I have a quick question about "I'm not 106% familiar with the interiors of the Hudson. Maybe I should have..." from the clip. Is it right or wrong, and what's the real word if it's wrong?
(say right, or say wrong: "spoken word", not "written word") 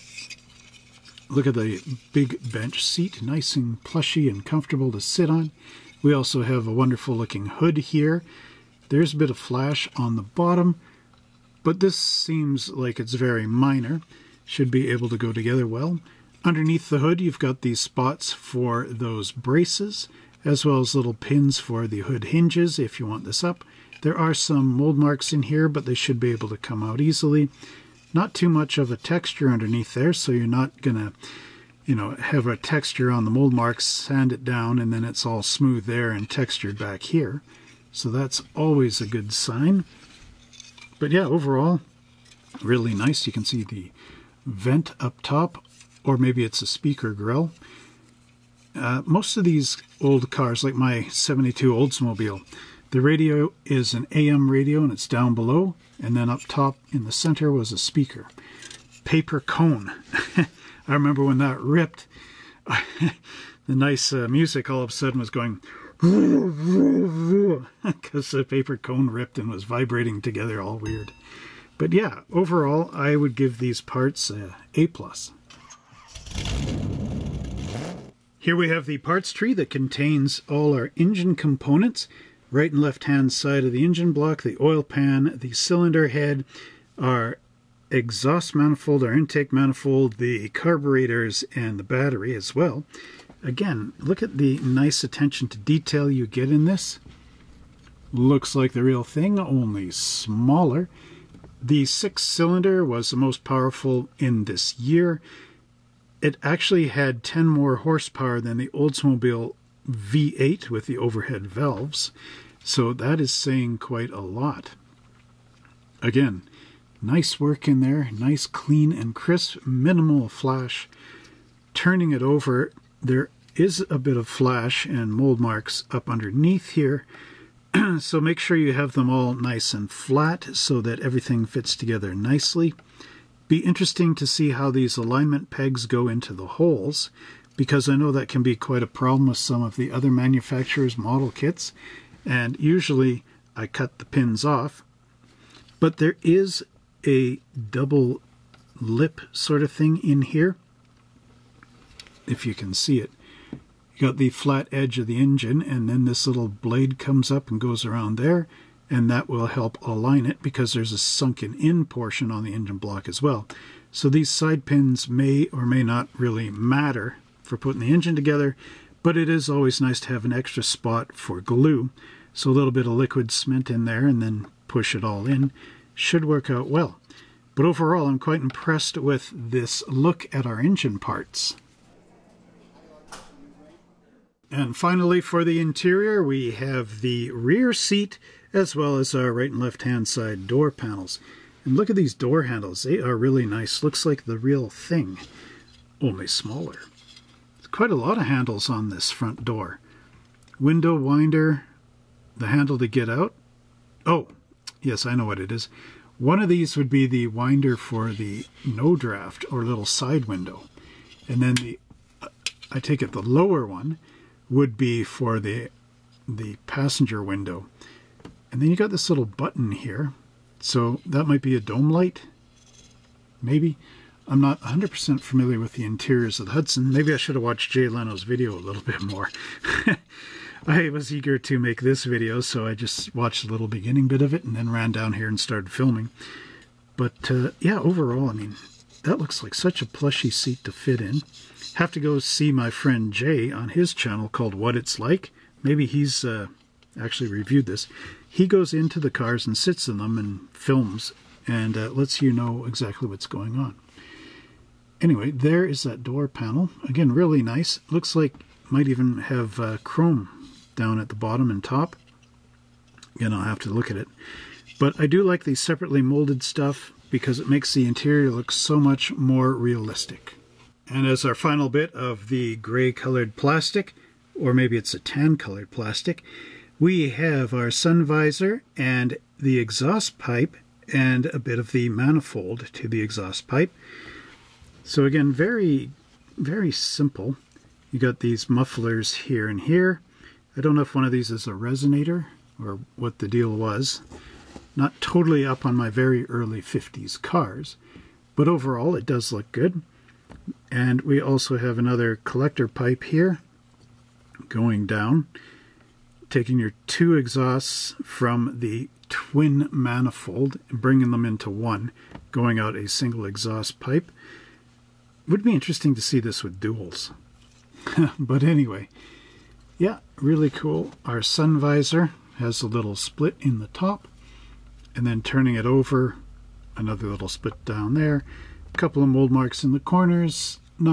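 wrong: "100", not "106".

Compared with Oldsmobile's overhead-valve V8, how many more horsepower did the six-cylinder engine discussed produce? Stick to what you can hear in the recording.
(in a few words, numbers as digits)
10.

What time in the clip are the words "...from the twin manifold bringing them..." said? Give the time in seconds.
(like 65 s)
308 s.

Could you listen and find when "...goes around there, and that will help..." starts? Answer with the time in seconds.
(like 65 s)
157 s.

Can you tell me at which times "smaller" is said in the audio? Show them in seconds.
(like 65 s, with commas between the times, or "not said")
99 s, 196 s.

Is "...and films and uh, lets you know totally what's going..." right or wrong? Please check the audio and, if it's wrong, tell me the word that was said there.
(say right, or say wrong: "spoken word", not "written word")
wrong: "exactly", not "totally".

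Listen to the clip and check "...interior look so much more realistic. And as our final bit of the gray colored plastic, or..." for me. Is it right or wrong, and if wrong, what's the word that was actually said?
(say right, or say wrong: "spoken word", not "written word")
right.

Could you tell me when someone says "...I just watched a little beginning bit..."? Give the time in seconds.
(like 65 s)
232 s.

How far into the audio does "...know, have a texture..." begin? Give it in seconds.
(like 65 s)
31 s.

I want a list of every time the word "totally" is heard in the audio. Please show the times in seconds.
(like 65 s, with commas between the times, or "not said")
294 s.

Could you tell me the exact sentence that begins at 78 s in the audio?
Here we have the parts tree that contains all our engine components.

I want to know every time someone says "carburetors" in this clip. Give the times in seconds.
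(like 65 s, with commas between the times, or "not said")
90 s.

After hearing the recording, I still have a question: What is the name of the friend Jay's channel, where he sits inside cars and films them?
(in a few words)
What It's Like.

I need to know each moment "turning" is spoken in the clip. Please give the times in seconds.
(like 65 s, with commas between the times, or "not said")
121 s, 325 s.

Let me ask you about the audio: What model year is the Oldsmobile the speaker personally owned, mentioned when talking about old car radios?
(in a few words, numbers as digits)
72.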